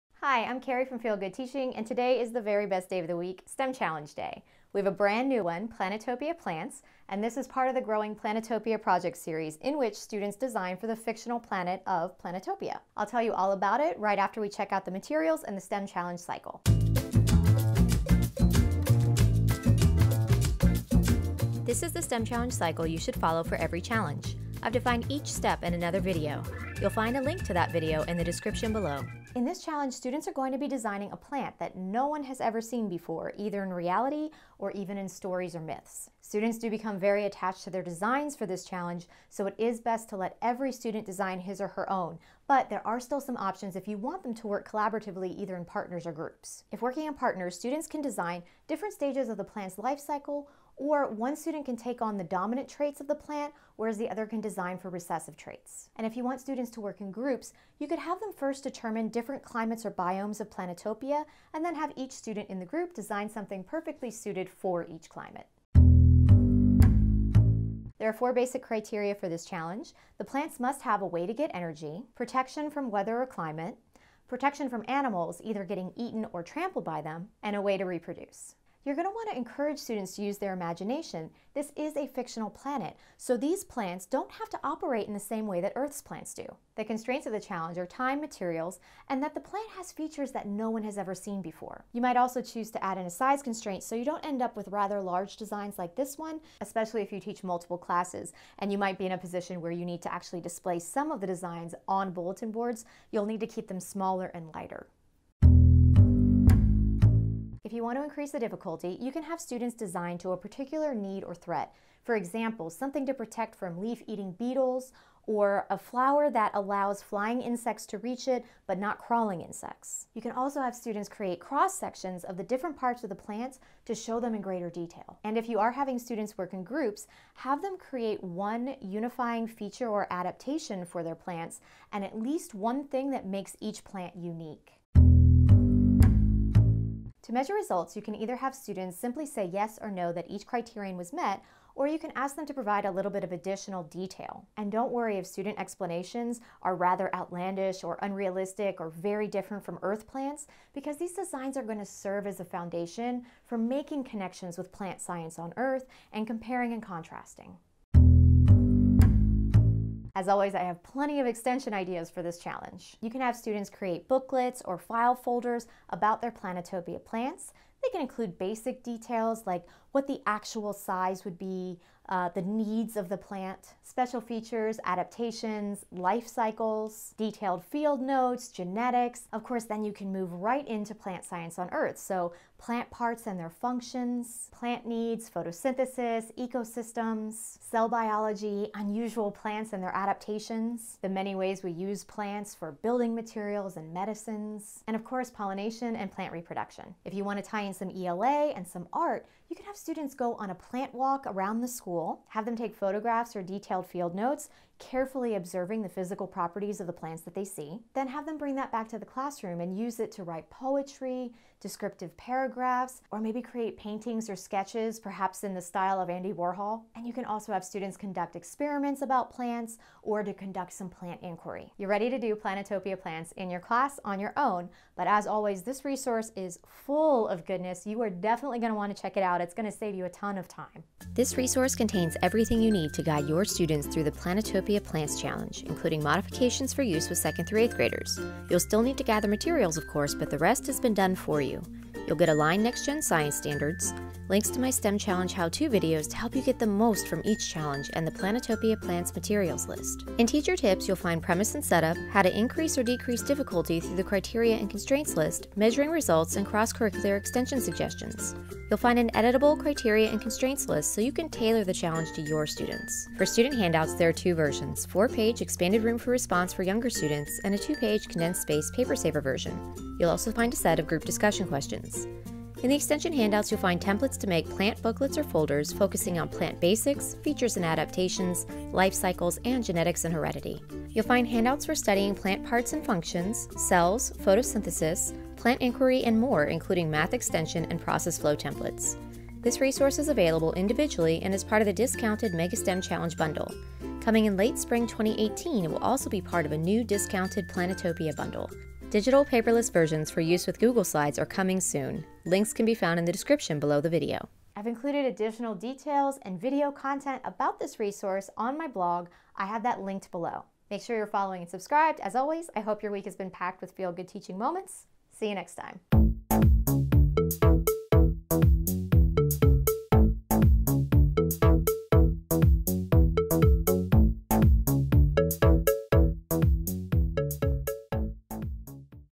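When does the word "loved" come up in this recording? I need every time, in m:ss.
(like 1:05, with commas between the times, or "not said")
not said.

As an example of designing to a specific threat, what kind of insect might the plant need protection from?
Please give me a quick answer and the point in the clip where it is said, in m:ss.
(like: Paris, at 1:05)
leaf-eating beetles, at 1:53.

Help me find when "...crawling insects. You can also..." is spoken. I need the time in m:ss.
1:58.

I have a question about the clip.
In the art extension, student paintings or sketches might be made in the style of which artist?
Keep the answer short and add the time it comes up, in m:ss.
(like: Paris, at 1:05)
Andy Warhol, at 3:36.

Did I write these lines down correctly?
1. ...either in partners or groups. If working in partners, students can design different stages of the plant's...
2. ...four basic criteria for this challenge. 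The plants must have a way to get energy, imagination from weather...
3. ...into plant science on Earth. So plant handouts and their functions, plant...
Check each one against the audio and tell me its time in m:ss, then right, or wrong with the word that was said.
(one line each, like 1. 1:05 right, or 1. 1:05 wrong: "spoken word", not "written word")
1. 0:45 right
2. 1:08 wrong: "protection", not "imagination"
3. 3:00 wrong: "parts", not "handouts".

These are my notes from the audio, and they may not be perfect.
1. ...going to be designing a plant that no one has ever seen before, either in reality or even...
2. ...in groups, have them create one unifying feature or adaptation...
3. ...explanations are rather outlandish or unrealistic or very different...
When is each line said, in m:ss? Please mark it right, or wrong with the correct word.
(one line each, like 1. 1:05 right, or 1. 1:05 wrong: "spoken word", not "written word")
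1. 0:30 right
2. 2:06 right
3. 2:25 right.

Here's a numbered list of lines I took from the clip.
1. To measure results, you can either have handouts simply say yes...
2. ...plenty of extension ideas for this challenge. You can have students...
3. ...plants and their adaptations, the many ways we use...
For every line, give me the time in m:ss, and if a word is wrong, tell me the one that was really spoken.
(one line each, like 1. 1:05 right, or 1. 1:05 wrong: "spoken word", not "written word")
1. 2:17 wrong: "students", not "handouts"
2. 2:40 right
3. 3:09 right.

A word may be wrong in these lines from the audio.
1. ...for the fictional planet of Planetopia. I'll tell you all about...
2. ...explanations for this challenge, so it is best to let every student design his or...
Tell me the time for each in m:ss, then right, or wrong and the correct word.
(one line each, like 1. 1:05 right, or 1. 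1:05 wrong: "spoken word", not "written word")
1. 0:10 right
2. 0:37 wrong: "designs", not "explanations".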